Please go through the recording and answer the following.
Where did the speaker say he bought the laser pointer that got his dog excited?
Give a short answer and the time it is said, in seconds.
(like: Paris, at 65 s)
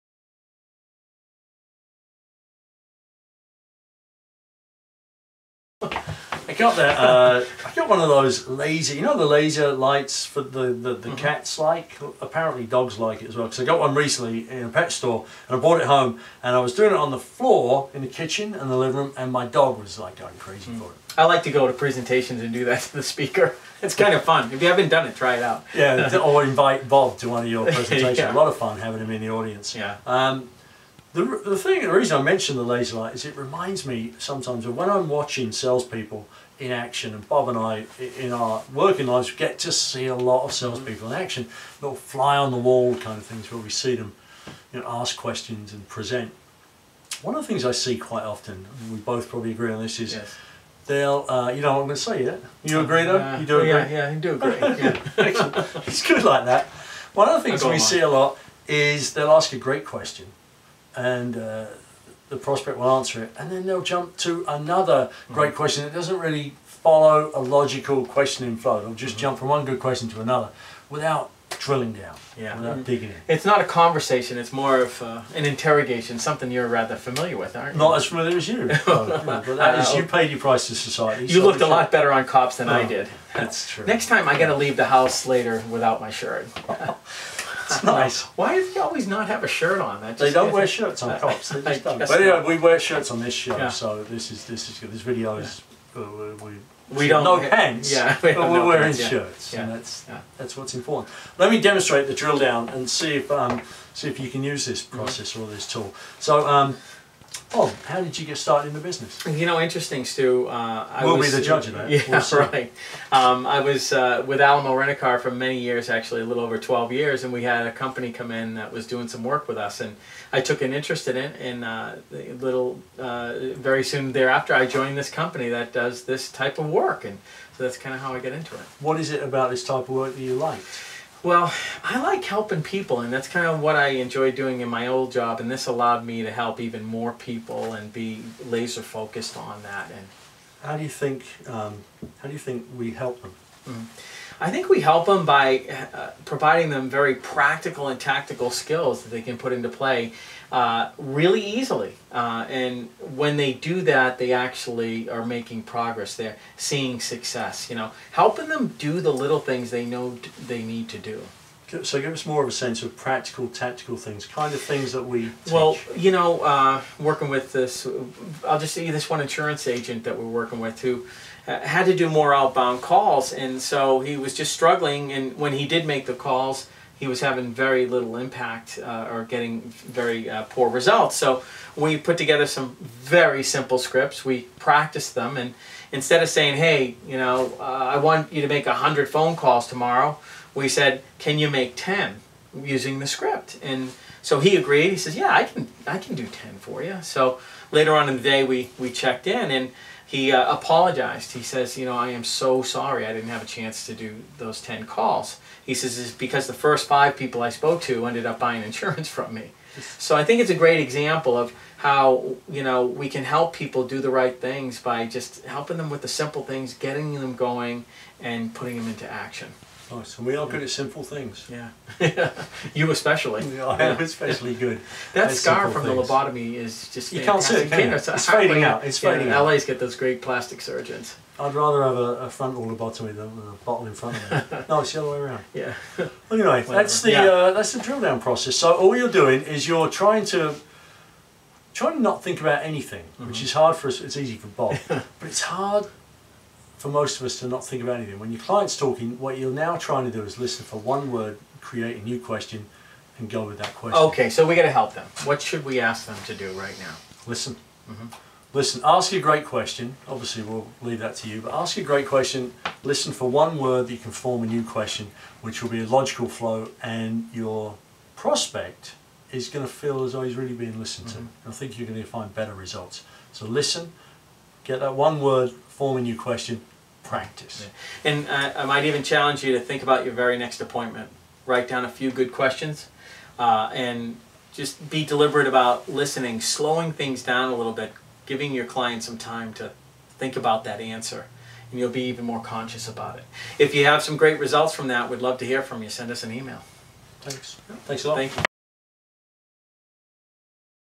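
pet store, at 14 s.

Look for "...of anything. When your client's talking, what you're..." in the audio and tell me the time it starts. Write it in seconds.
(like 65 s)
247 s.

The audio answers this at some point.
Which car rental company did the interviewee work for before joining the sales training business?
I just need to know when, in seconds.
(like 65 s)
114 s.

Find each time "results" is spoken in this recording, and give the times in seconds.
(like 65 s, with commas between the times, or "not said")
180 s, 272 s, 294 s.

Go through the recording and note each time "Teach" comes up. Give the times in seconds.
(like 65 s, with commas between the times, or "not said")
165 s.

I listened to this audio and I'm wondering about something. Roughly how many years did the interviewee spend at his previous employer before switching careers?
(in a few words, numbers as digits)
12 years.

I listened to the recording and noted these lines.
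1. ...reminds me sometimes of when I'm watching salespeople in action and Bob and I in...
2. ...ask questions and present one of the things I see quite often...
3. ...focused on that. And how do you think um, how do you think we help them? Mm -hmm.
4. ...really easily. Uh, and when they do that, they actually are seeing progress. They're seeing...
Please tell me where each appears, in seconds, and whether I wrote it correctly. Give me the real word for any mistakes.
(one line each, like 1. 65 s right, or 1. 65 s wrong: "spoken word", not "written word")
1. 33 s right
2. 44 s right
3. 138 s right
4. 150 s wrong: "making", not "seeing".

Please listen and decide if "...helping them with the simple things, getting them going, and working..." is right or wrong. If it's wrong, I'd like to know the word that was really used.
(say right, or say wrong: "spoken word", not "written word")
wrong: "putting", not "working".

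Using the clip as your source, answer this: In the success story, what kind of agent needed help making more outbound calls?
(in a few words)
insurance agent.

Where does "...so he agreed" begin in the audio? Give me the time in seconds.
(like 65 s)
194 s.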